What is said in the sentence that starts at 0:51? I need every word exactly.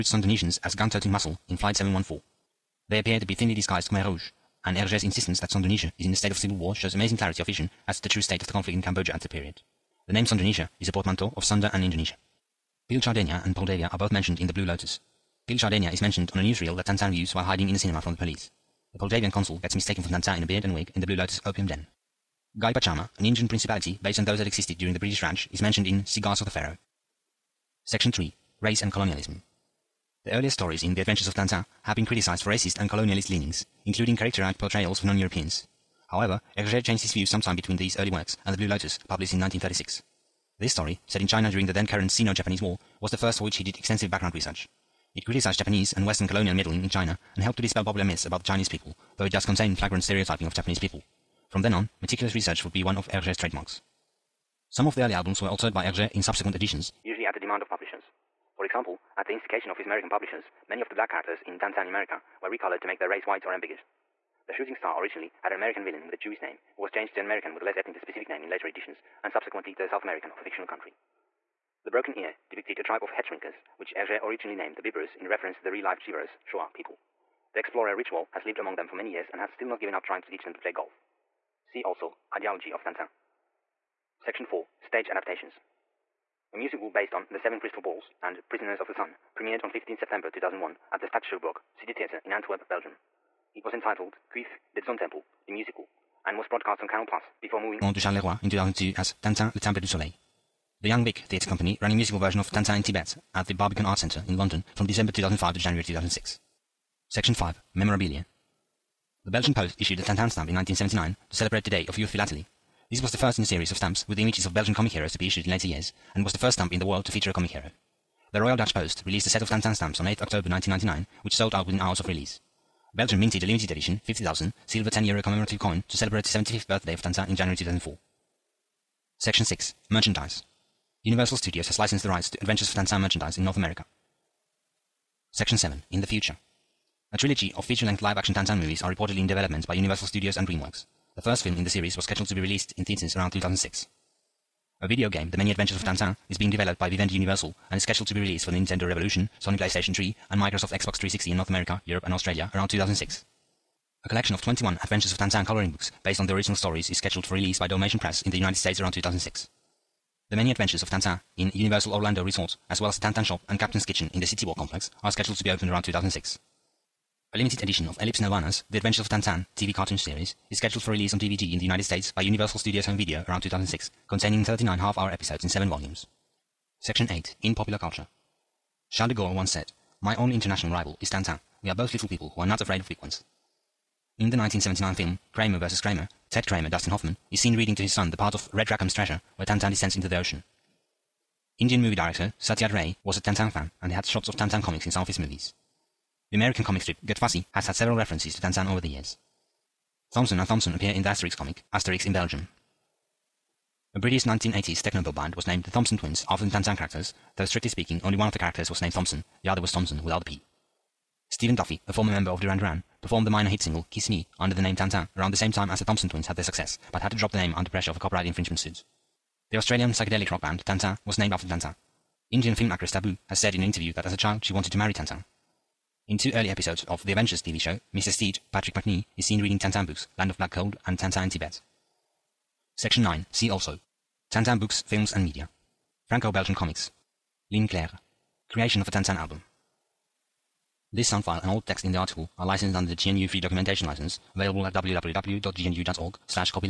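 From then on, meticulous research would be one of Hergé's trademarks.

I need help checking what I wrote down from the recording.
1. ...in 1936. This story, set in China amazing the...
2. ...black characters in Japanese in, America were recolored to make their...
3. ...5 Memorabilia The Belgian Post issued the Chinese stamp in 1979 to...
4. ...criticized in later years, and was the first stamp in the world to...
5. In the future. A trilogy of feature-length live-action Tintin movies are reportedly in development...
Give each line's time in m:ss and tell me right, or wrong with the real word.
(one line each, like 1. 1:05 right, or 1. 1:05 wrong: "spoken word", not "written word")
1. 0:39 wrong: "during", not "amazing"
2. 1:00 wrong: "Tintin", not "Japanese"
3. 1:47 wrong: "Tintin", not "Chinese"
4. 1:55 wrong: "issued", not "criticized"
5. 2:15 right.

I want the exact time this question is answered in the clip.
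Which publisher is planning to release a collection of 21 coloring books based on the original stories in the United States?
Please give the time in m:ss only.
2:37.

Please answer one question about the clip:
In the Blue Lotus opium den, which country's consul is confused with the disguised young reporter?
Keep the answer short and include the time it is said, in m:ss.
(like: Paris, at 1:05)
Poldavia, at 0:18.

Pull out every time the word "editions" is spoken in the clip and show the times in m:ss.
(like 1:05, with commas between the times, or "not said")
0:56, 1:08, 2:03, 2:47.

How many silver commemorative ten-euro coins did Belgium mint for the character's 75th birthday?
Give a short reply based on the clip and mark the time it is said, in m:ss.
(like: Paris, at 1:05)
50,000, at 2:04.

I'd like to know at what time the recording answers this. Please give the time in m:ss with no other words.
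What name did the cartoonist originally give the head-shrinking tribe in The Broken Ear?
1:14.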